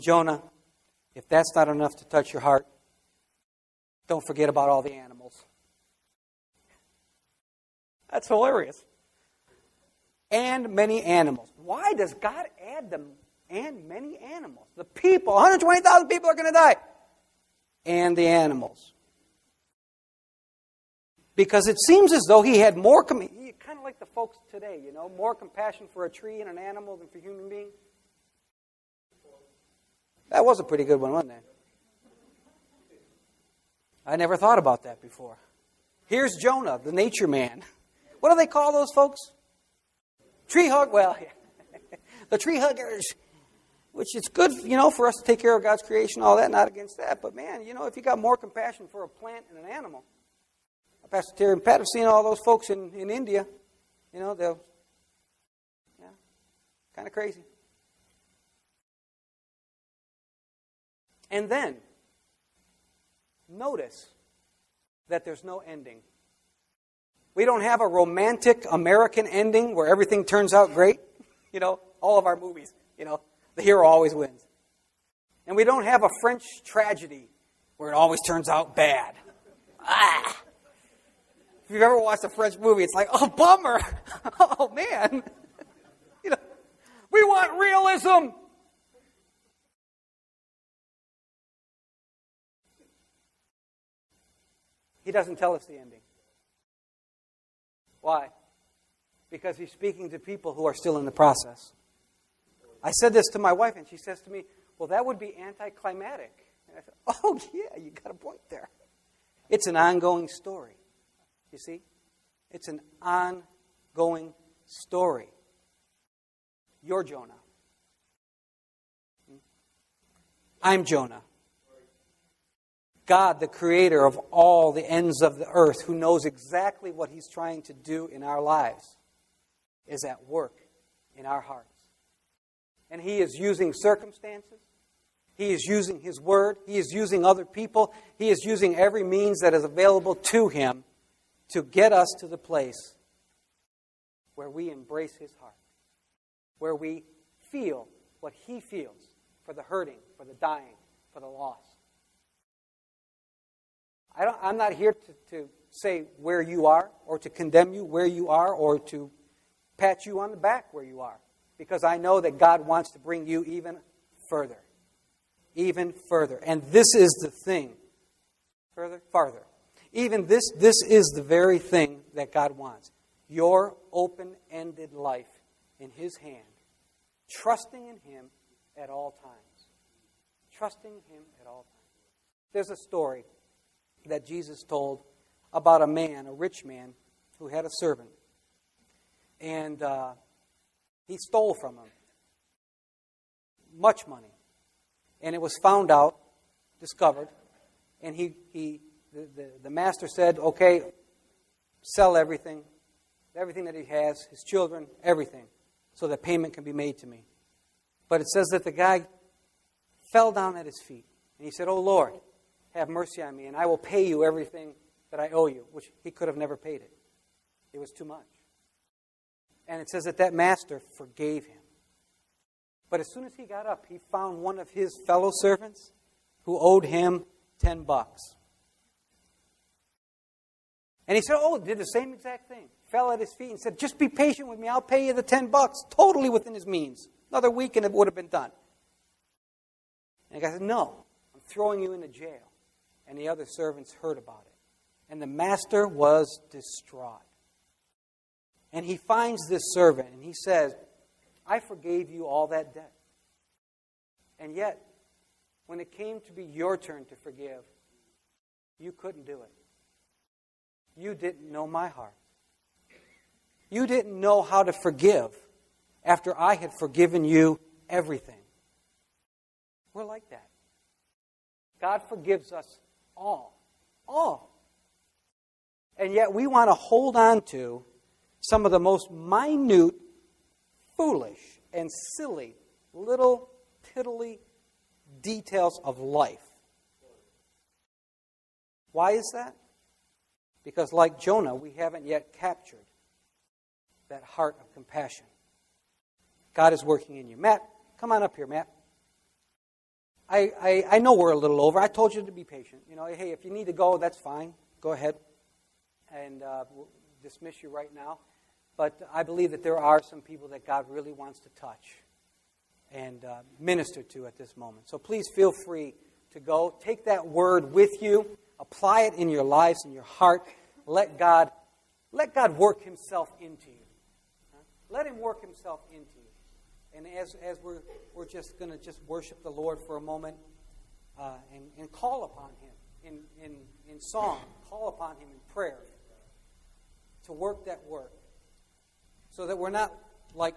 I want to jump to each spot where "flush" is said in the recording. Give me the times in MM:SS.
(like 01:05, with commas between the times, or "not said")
not said.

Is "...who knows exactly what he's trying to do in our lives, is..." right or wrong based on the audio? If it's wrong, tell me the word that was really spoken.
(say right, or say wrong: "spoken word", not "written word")
right.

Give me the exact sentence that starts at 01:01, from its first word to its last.
And then, notice that there's no ending.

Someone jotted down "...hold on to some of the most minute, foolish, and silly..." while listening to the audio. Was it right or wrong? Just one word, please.
right.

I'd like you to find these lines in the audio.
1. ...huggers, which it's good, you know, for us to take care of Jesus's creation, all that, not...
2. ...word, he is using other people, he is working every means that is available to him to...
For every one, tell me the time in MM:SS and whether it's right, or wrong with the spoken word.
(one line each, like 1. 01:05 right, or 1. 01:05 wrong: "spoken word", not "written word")
1. 00:42 wrong: "God", not "Jesus"
2. 02:16 wrong: "using", not "working".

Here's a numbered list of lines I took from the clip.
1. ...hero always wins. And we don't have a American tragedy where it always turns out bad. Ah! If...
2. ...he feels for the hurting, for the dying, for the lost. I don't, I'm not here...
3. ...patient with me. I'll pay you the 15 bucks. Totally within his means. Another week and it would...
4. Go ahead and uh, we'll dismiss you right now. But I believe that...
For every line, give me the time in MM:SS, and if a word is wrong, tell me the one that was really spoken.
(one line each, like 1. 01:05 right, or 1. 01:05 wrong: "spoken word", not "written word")
1. 01:13 wrong: "French", not "American"
2. 02:28 right
3. 03:54 wrong: "10", not "15"
4. 05:04 right.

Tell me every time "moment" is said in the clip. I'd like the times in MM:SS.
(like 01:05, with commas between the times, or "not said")
05:14, 05:30.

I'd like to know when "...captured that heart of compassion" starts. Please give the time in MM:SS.
04:52.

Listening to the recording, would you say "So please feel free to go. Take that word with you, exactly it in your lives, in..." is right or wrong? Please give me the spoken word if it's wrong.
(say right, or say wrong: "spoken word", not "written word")
wrong: "apply", not "exactly".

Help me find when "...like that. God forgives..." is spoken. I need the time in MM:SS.
04:30.